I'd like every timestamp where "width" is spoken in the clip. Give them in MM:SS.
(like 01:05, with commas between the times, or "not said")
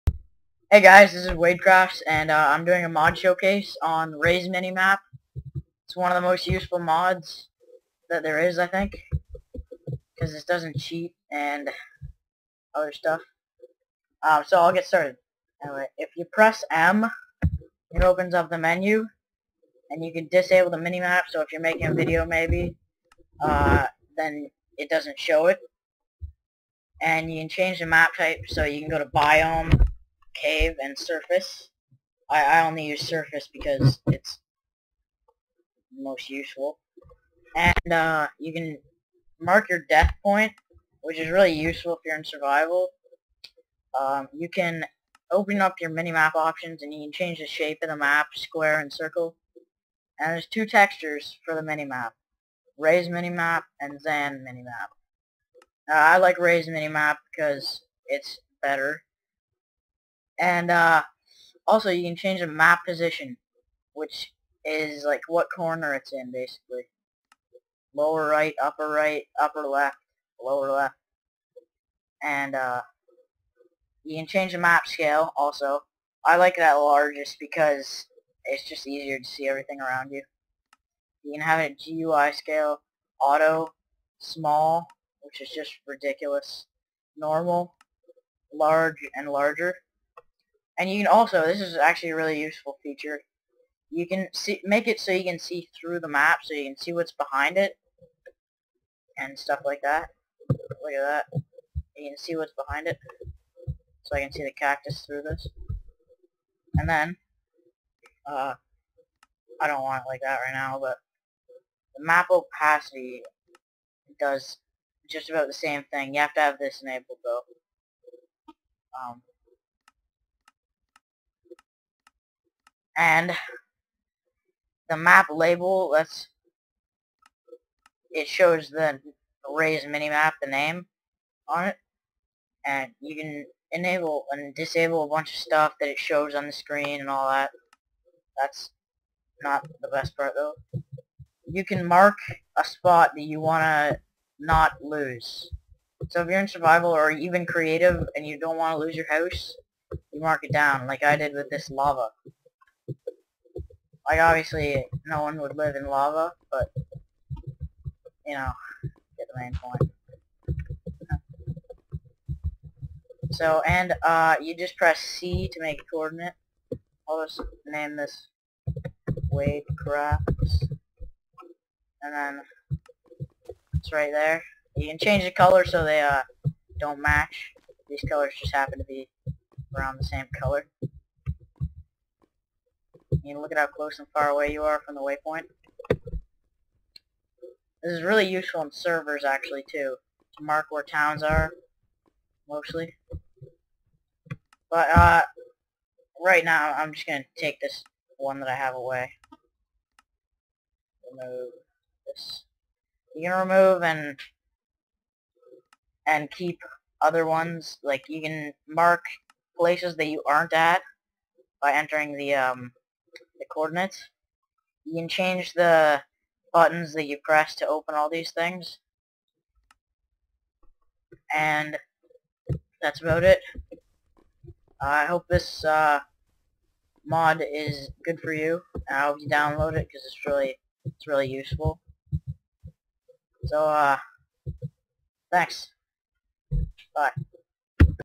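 not said.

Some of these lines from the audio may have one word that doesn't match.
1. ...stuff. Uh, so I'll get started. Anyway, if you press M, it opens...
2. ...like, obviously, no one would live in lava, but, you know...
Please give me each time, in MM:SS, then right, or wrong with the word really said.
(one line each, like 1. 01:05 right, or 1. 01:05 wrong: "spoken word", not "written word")
1. 00:12 right
2. 02:34 right.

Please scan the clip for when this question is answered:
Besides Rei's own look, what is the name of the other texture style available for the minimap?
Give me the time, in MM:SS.
00:53.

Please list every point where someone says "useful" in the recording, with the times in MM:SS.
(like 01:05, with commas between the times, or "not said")
00:06, 00:36, 00:41, 01:32, 03:08, 03:51.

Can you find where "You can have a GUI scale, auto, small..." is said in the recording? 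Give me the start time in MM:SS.
01:21.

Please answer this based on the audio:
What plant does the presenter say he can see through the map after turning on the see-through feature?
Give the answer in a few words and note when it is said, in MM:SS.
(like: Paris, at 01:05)
cactus, at 01:44.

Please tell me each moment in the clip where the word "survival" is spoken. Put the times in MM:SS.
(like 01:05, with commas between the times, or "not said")
00:42, 02:26.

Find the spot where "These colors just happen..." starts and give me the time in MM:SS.
02:57.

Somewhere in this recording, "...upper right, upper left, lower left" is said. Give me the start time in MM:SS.
01:08.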